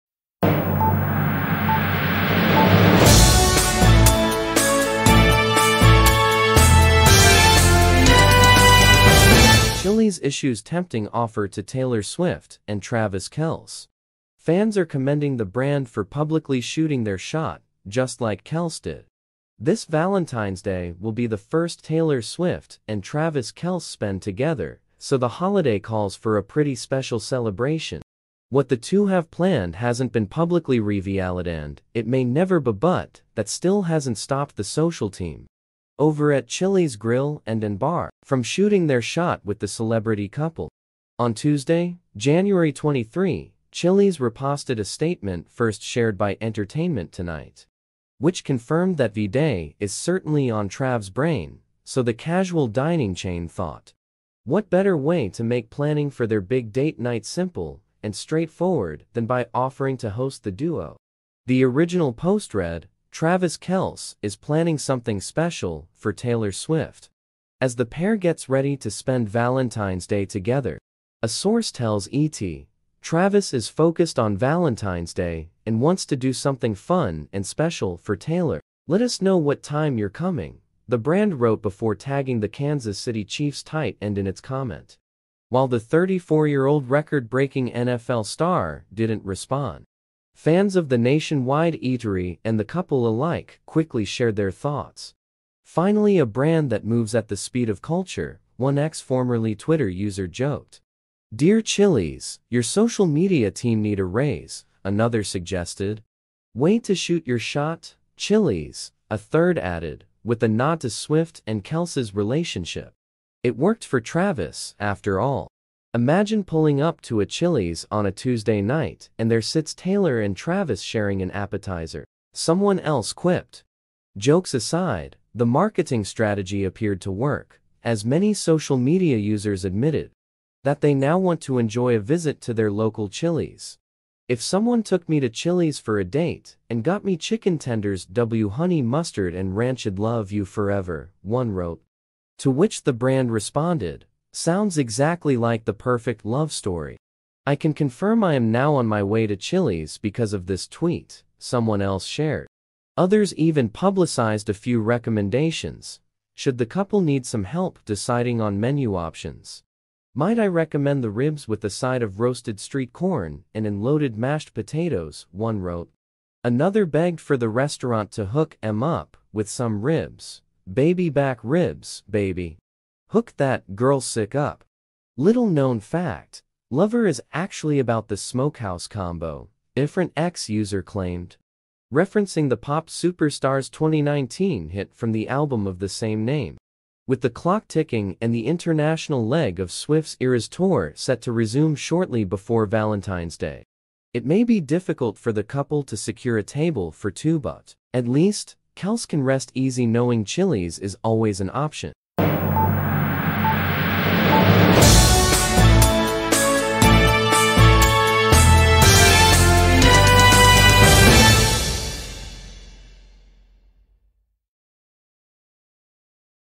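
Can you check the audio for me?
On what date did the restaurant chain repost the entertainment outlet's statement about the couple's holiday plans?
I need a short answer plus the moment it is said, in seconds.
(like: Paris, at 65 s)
January 23, at 42 s.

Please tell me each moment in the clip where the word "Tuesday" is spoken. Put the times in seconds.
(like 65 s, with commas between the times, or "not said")
41 s, 118 s.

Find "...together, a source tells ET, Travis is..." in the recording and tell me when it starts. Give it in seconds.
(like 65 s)
70 s.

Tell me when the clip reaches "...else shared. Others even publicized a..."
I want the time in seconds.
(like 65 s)
151 s.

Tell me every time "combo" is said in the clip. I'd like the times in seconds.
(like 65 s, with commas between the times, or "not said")
178 s.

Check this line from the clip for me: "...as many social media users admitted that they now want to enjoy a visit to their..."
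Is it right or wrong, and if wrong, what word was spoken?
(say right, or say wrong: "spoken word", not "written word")
right.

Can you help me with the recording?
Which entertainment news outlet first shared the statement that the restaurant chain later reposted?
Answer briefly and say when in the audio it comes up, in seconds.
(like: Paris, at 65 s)
Entertainment Tonight, at 46 s.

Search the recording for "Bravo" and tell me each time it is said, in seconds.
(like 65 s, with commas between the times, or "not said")
not said.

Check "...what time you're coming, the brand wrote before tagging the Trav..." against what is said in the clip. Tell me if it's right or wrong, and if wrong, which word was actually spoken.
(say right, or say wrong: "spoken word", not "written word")
wrong: "Kansas", not "Trav".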